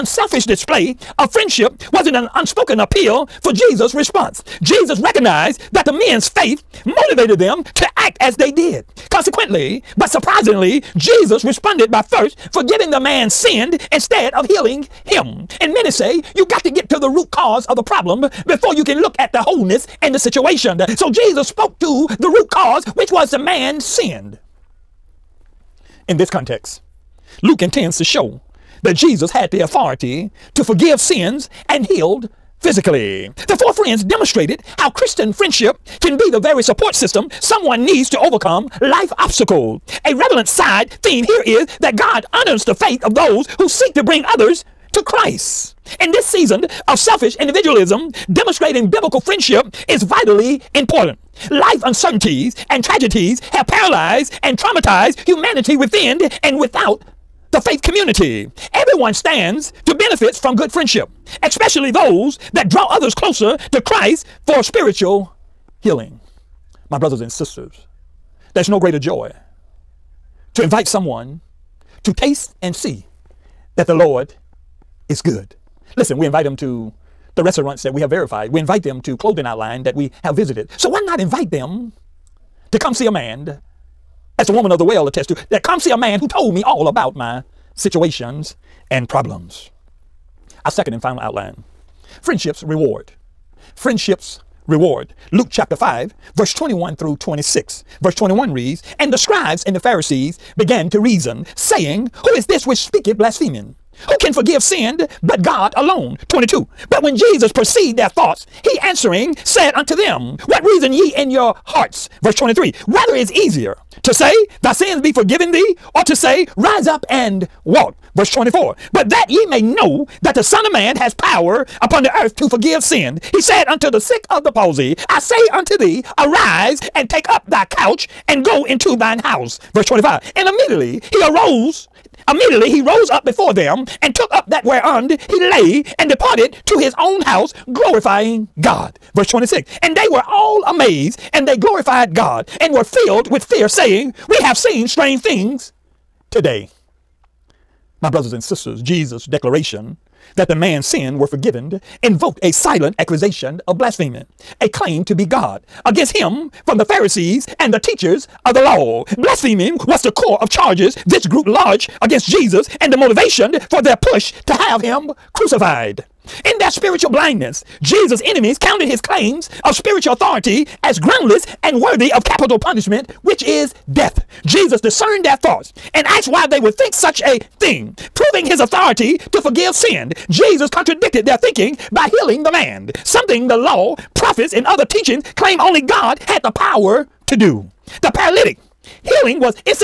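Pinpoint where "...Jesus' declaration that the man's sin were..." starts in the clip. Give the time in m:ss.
2:28.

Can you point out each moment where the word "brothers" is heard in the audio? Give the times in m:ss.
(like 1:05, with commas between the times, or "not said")
1:06, 2:28.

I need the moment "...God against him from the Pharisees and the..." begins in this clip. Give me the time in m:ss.
2:35.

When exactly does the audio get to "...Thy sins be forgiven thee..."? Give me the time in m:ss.
1:54.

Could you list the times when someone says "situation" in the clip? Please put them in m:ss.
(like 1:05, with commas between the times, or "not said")
0:20, 1:27.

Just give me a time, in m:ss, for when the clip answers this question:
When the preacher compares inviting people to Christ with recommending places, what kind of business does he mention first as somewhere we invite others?
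1:17.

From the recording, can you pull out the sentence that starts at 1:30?
Our second and final outline friendships reward.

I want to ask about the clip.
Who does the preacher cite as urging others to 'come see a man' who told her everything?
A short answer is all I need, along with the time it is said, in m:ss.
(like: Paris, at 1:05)
the woman of the well, at 1:24.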